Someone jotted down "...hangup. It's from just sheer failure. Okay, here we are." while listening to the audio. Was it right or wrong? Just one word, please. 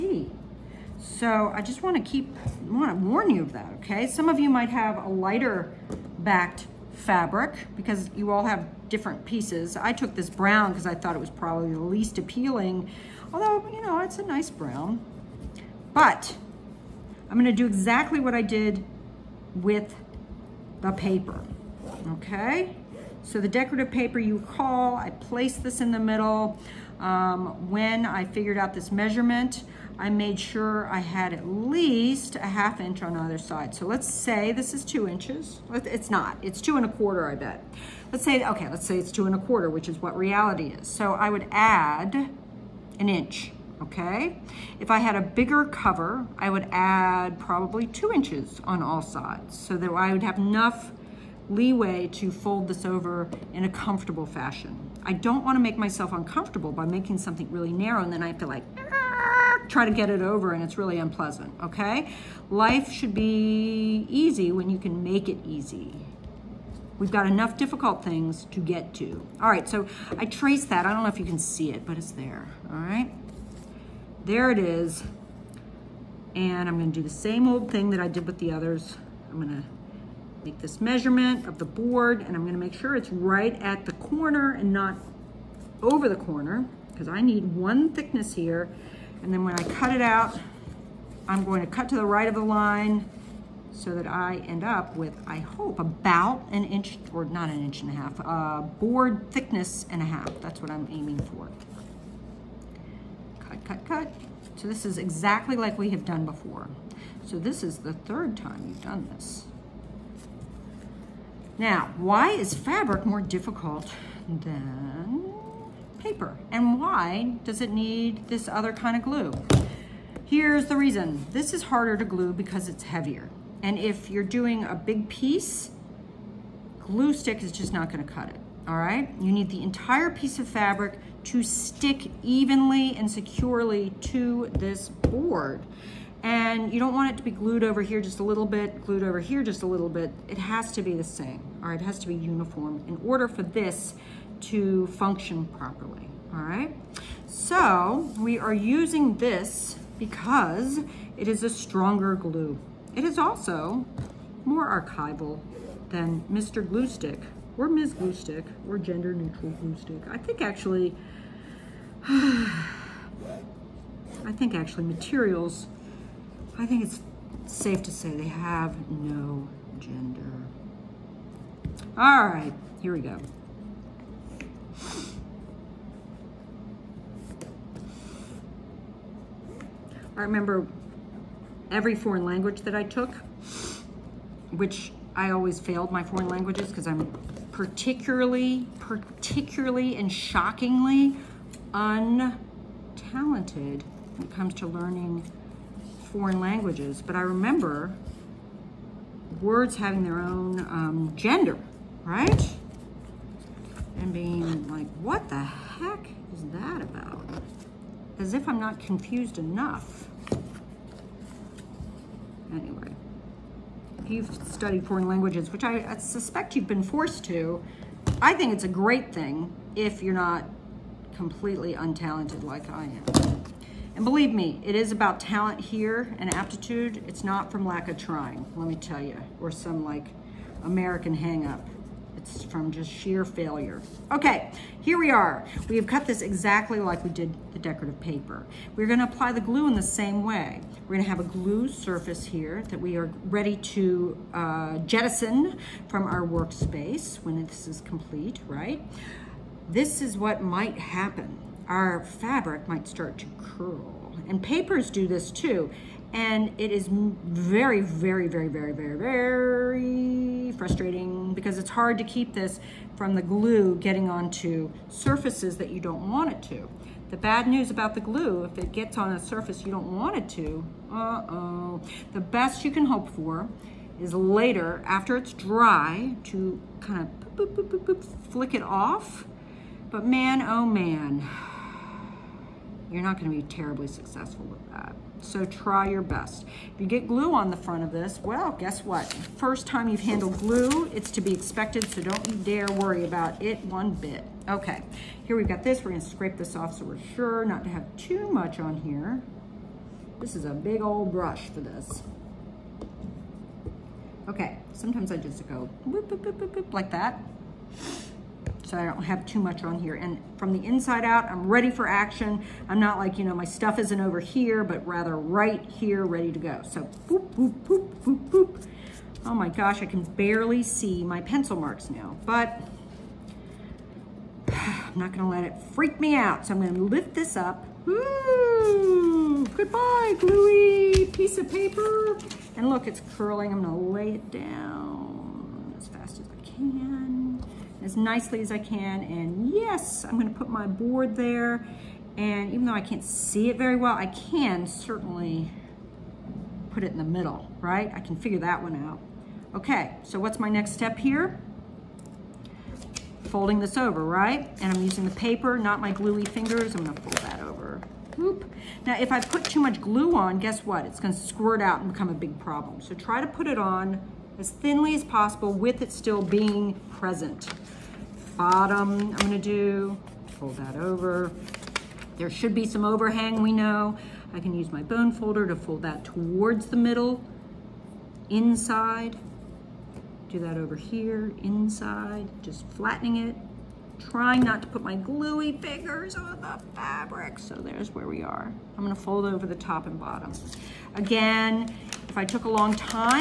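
right.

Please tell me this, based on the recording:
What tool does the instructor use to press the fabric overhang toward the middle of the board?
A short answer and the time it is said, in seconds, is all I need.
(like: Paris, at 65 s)
bone folder, at 374 s.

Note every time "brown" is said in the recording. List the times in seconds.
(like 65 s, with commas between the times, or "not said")
10 s, 14 s.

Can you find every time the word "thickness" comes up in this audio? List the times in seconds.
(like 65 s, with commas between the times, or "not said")
87 s, 99 s.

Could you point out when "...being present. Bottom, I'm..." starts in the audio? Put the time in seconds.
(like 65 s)
366 s.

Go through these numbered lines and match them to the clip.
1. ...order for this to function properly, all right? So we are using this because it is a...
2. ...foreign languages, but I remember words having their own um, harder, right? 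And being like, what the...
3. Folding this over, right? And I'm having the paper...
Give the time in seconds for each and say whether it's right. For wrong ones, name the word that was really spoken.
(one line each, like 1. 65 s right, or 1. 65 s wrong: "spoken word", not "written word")
1. 143 s right
2. 196 s wrong: "gender", not "harder"
3. 353 s wrong: "using", not "having".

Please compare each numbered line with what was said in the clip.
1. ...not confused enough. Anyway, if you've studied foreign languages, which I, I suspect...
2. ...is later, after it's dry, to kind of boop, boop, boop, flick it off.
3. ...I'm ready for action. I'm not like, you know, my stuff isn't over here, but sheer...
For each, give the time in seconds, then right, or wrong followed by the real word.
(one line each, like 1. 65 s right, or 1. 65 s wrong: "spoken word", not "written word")
1. 208 s right
2. 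273 s right
3. 311 s wrong: "rather", not "sheer".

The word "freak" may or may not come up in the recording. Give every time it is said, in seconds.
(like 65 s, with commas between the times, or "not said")
325 s.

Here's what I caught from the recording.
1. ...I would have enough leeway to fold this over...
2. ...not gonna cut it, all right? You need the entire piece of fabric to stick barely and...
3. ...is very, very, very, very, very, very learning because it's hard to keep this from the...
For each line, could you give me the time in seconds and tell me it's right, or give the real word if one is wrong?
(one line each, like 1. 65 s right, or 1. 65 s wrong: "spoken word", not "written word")
1. 49 s right
2. 127 s wrong: "evenly", not "barely"
3. 256 s wrong: "frustrating", not "learning".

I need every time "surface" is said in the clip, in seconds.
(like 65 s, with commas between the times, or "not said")
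241 s, 264 s, 269 s.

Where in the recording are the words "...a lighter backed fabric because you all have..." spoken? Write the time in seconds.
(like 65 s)
5 s.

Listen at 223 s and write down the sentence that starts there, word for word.
And believe me, it is about talent here and aptitude.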